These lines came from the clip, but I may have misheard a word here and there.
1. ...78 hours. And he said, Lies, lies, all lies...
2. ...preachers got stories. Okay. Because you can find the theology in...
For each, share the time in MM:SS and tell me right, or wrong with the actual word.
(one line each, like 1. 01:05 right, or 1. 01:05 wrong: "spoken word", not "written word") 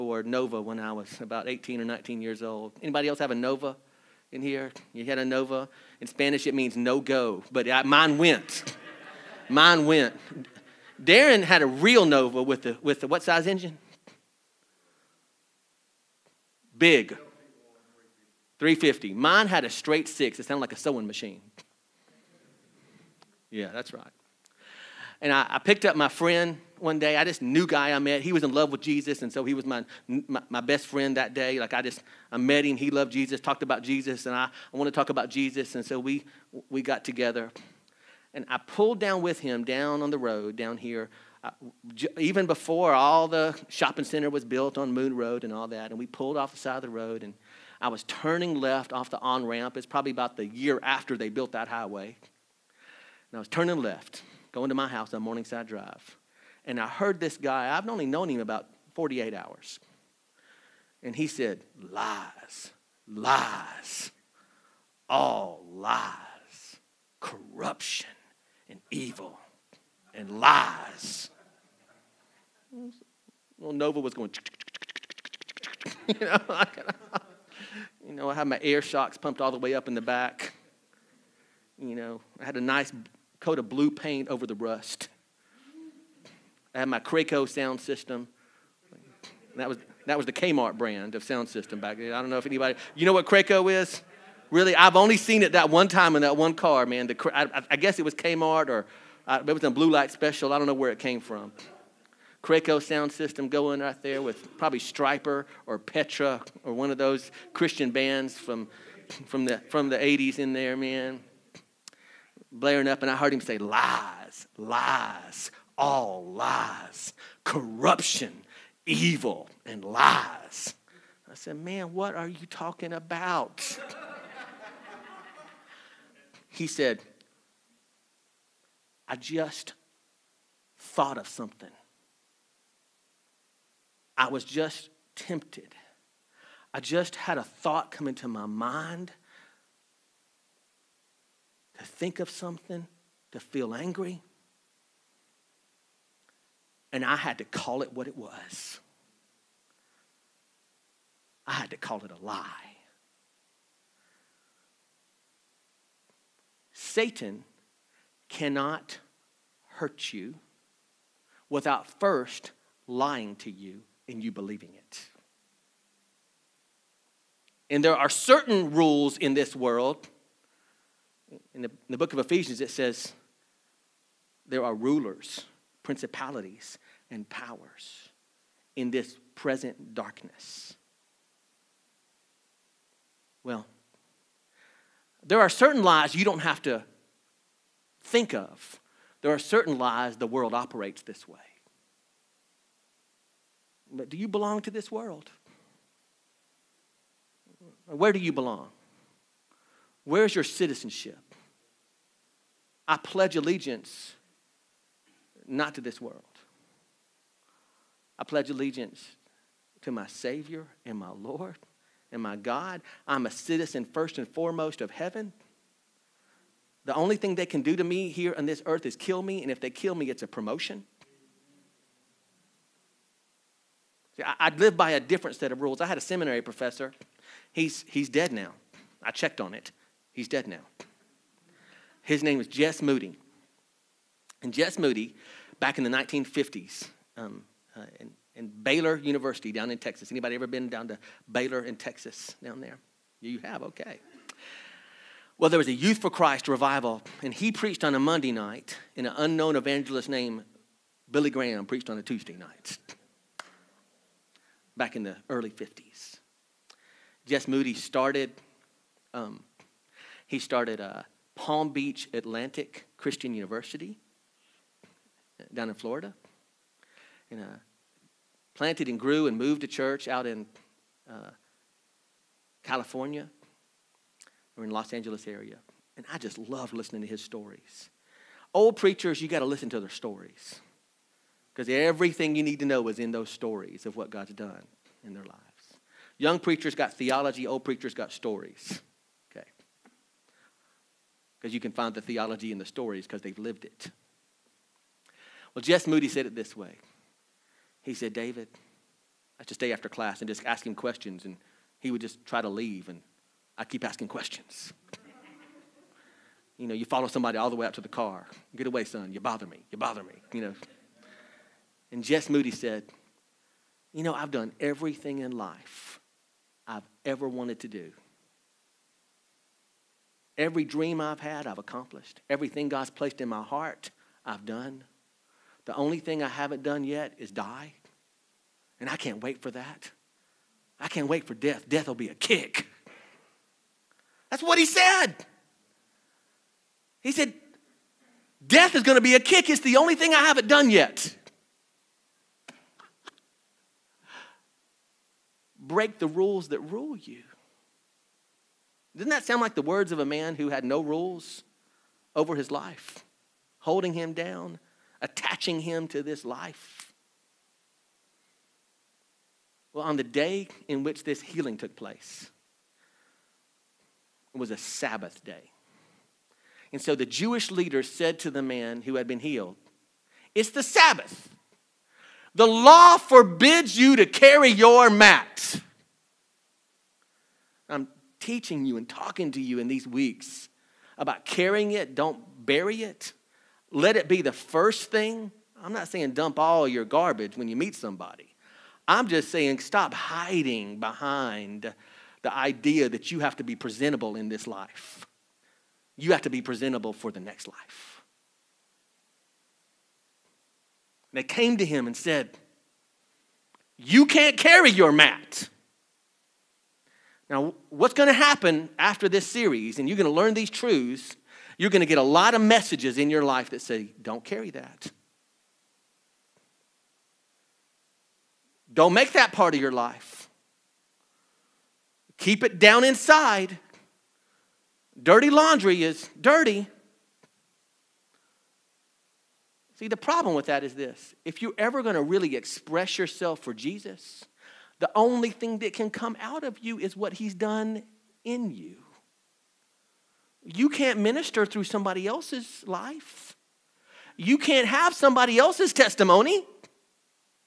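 1. 00:58 wrong: "48", not "78"
2. 04:47 right.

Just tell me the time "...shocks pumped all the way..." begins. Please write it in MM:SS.
01:18.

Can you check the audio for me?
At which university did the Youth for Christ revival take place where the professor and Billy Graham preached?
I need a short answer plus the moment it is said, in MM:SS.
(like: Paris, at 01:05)
Baylor University, at 03:58.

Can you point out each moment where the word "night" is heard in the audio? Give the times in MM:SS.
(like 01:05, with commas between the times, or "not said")
04:08, 04:12.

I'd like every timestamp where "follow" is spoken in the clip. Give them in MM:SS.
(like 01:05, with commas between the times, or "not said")
05:06.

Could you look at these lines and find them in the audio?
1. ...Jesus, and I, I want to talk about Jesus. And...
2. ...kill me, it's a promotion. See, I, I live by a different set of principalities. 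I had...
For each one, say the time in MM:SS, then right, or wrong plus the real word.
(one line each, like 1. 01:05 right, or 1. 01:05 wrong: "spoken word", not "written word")
1. 00:33 right
2. 03:39 wrong: "rules", not "principalities".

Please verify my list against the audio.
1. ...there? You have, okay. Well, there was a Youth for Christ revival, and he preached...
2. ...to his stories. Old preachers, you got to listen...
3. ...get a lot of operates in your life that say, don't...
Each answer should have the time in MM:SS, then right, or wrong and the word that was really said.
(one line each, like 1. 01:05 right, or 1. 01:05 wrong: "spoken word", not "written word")
1. 04:02 right
2. 04:37 right
3. 06:51 wrong: "messages", not "operates".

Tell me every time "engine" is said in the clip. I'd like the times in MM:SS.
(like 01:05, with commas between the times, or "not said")
00:13.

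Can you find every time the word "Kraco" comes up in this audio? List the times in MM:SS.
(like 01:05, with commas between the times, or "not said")
01:27, 01:33, 01:42.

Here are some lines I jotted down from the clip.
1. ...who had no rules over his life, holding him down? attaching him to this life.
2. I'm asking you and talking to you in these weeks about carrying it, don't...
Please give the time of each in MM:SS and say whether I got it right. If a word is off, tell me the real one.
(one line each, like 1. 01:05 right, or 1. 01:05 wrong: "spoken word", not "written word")
1. 05:50 right
2. 06:17 wrong: "teaching", not "asking".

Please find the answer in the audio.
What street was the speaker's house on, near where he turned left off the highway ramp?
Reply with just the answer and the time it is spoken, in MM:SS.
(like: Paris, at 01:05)
Morningside Drive, at 00:55.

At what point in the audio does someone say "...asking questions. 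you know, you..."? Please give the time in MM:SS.
05:03.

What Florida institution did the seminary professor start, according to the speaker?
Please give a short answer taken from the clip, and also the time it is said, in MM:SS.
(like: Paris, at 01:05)
Palm Beach Atlantic Christian University, at 04:21.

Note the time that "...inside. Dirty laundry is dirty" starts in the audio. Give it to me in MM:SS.
07:02.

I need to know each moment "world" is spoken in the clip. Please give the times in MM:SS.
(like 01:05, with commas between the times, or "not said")
02:49, 03:10, 03:14, 03:26.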